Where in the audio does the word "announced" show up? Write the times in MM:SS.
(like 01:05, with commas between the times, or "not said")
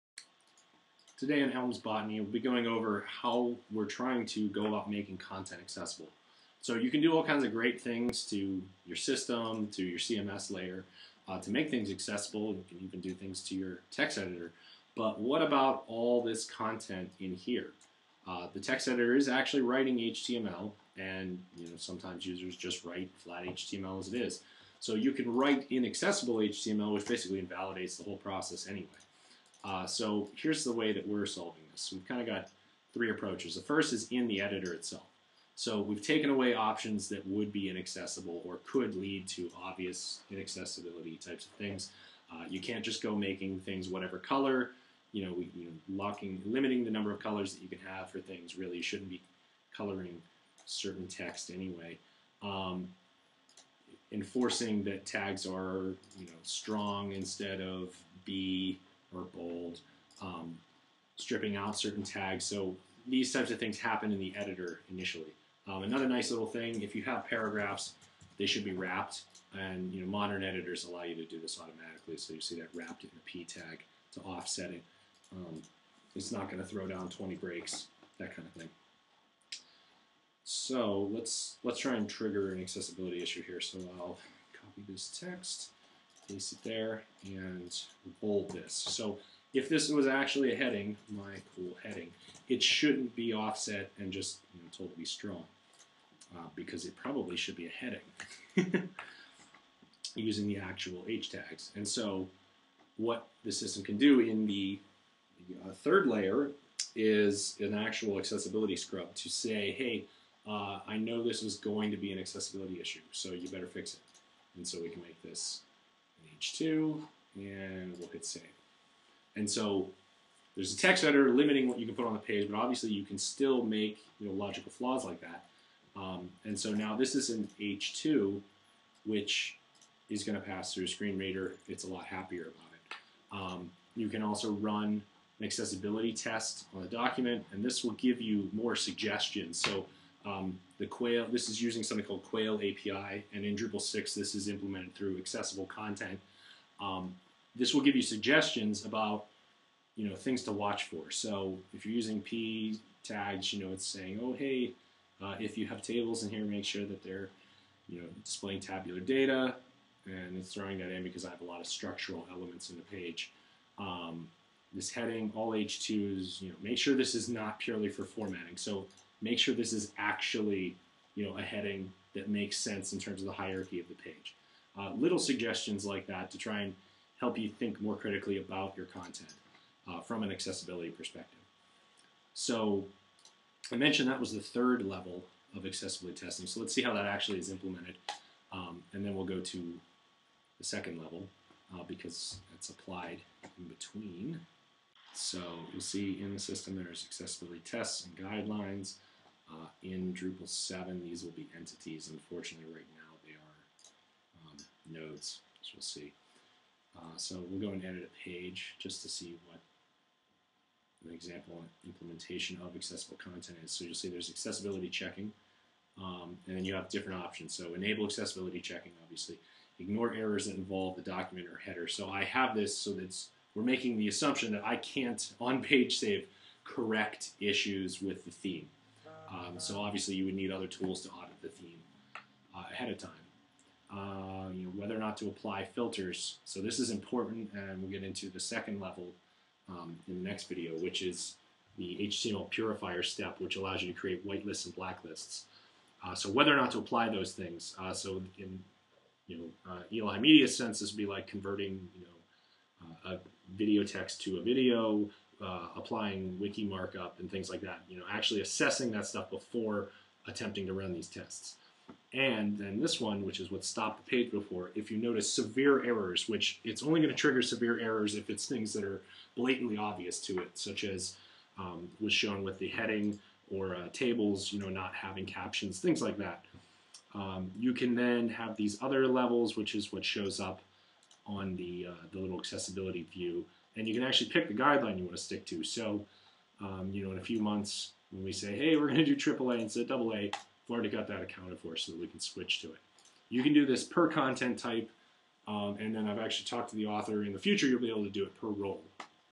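not said.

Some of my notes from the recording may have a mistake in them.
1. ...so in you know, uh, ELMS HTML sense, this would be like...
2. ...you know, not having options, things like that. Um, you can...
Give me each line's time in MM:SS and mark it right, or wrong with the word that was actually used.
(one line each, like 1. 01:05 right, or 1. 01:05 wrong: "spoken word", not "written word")
1. 04:07 wrong: "Media", not "HTML"
2. 04:34 wrong: "captions", not "options".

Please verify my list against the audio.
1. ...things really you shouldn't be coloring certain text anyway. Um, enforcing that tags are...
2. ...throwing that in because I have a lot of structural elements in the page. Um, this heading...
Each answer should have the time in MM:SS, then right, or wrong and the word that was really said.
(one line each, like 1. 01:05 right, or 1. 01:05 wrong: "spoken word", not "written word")
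1. 00:48 right
2. 02:40 right.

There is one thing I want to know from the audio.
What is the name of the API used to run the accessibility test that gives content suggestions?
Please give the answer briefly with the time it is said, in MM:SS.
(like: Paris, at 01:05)
Quail API, at 02:22.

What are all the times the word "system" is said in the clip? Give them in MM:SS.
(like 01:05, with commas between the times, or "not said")
00:08, 01:43, 03:16.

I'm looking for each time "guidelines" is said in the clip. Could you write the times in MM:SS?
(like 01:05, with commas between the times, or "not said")
03:18, 04:44.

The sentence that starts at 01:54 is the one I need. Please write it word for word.
And so we can make this H2, and we'll hit save.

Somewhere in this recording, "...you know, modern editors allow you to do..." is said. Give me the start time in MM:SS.
01:09.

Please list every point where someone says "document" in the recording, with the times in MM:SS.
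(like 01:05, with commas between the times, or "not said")
02:16, 03:41.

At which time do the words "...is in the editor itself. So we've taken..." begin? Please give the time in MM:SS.
00:33.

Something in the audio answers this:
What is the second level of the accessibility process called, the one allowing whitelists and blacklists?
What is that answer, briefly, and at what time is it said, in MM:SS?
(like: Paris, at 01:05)
HTML purifier, at 04:02.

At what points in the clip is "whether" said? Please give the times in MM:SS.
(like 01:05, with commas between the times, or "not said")
03:54, 04:06.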